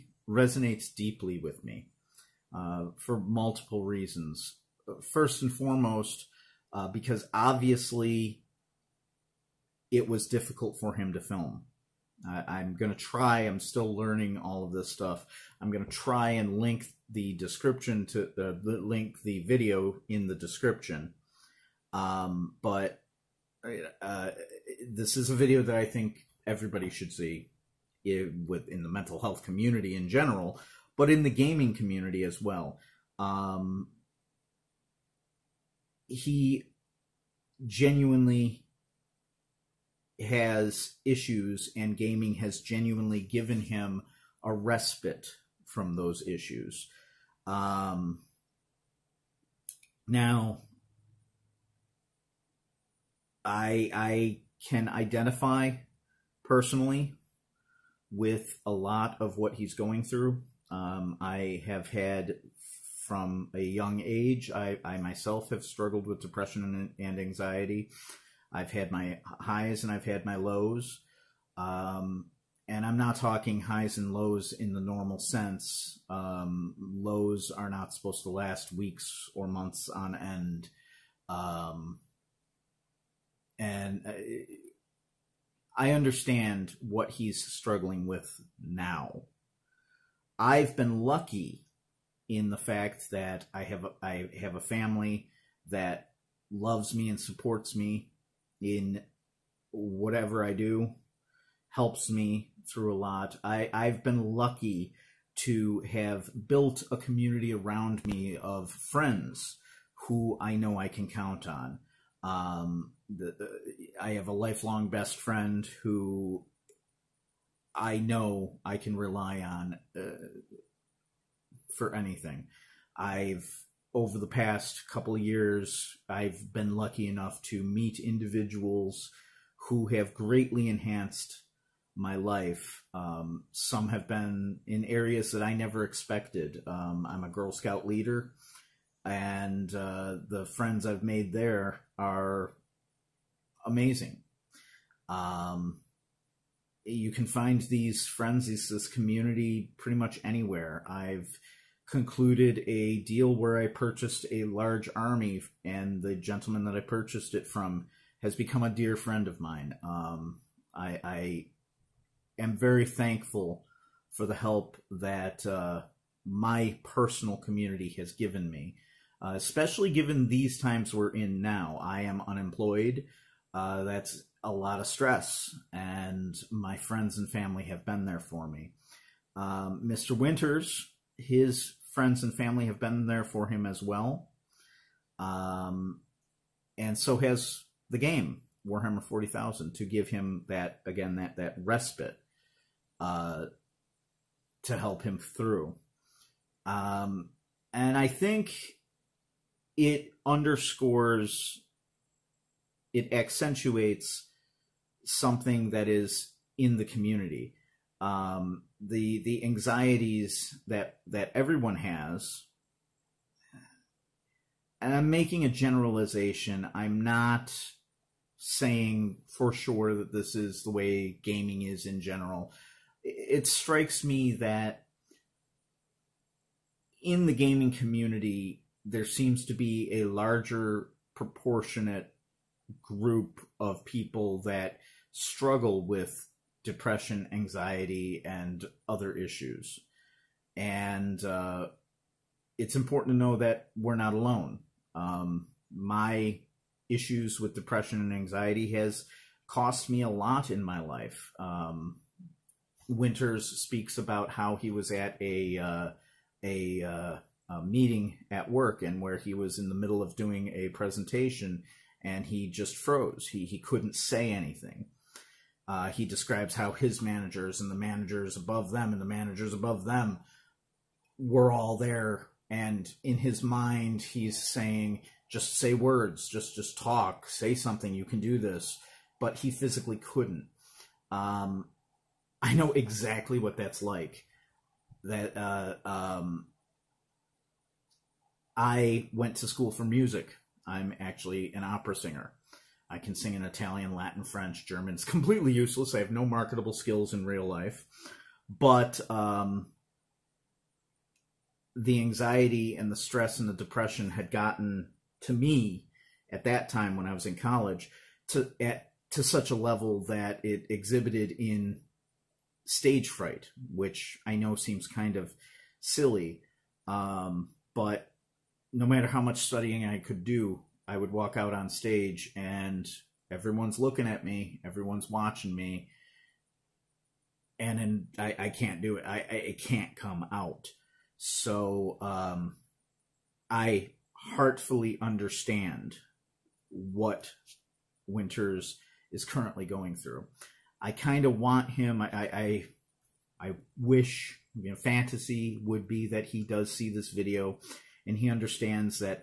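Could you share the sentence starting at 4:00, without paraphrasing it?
And uh, it's important to know that we're not alone.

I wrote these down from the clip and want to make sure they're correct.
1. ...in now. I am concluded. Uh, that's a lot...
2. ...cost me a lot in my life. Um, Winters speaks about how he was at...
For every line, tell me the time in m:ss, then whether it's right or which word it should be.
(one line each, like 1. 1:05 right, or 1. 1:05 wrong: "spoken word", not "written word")
1. 2:51 wrong: "unemployed", not "concluded"
2. 4:09 right.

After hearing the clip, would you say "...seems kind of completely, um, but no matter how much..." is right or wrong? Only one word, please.
wrong.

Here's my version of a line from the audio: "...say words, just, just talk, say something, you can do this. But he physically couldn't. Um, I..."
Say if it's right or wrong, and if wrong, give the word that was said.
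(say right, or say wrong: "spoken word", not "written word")
right.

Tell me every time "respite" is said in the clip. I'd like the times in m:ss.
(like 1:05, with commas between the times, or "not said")
0:44, 3:11.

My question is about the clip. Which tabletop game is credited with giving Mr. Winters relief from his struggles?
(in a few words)
Warhammer 40,000.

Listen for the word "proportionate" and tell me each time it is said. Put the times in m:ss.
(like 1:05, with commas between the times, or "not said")
3:51.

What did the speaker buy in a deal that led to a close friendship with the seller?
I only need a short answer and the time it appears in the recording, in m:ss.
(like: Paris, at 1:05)
A large army, at 2:34.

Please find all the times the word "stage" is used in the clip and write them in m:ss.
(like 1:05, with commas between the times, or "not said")
5:12, 5:21.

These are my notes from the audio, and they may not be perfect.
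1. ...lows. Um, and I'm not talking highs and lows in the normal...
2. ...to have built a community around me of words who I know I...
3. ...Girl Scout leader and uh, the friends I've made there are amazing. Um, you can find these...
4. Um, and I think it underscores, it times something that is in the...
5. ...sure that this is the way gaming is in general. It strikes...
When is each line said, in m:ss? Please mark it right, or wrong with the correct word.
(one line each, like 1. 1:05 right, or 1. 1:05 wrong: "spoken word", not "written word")
1. 1:10 right
2. 1:45 wrong: "friends", not "words"
3. 2:17 right
4. 3:16 wrong: "accentuates", not "times"
5. 3:39 right.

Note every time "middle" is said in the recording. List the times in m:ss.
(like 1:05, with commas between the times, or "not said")
4:19.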